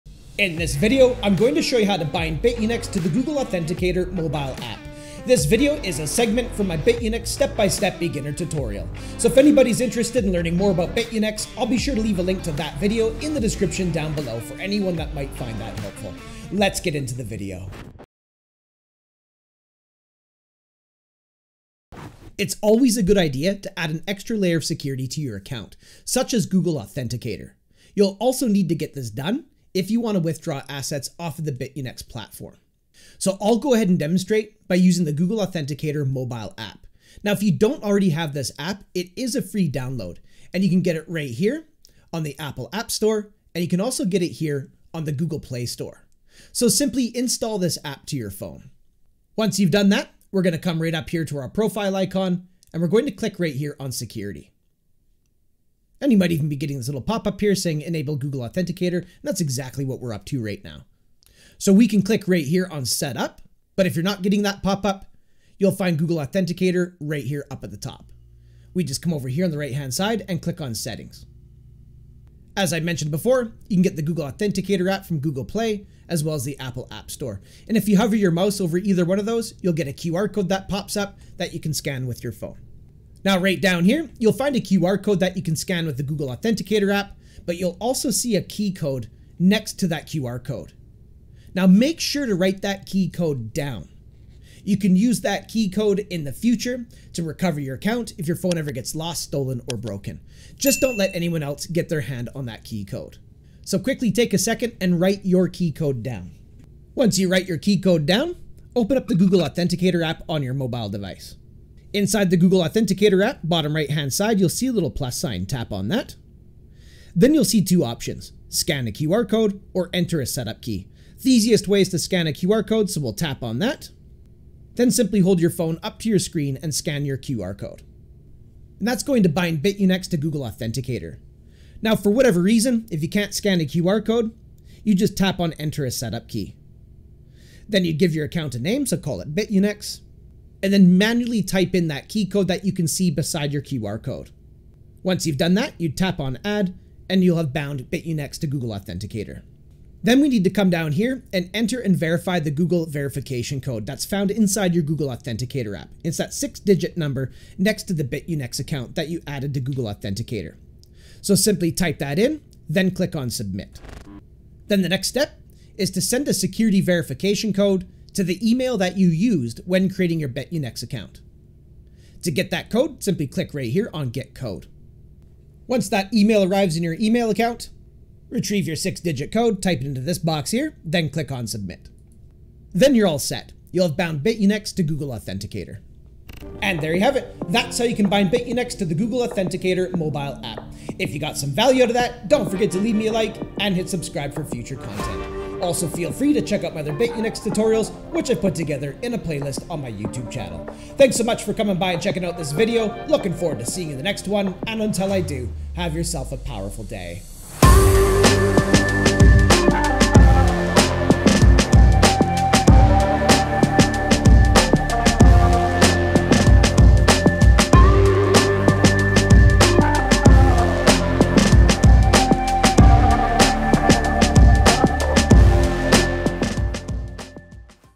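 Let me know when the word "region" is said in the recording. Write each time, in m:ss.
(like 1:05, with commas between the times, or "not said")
not said.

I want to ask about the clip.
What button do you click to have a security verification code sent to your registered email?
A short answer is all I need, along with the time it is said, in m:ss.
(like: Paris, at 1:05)
Get Code, at 2:54.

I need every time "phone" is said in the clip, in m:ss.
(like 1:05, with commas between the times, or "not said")
0:48, 1:22, 1:38, 2:05.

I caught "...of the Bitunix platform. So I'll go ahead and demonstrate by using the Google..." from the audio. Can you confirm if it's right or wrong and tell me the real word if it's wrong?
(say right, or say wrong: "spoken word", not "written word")
right.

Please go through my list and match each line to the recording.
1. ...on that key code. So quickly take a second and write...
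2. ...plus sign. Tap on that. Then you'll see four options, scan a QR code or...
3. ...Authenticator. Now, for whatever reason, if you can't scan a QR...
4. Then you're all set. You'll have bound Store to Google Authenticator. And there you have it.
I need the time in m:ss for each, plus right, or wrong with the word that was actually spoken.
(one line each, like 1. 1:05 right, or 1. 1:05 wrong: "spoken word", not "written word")
1. 1:42 right
2. 1:54 wrong: "two", not "four"
3. 2:10 right
4. 3:02 wrong: "Bitunix", not "Store".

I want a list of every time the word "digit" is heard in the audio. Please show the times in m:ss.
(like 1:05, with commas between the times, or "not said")
2:36, 2:58.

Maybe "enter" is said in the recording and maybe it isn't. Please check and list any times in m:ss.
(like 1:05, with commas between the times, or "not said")
1:59, 2:15, 2:31.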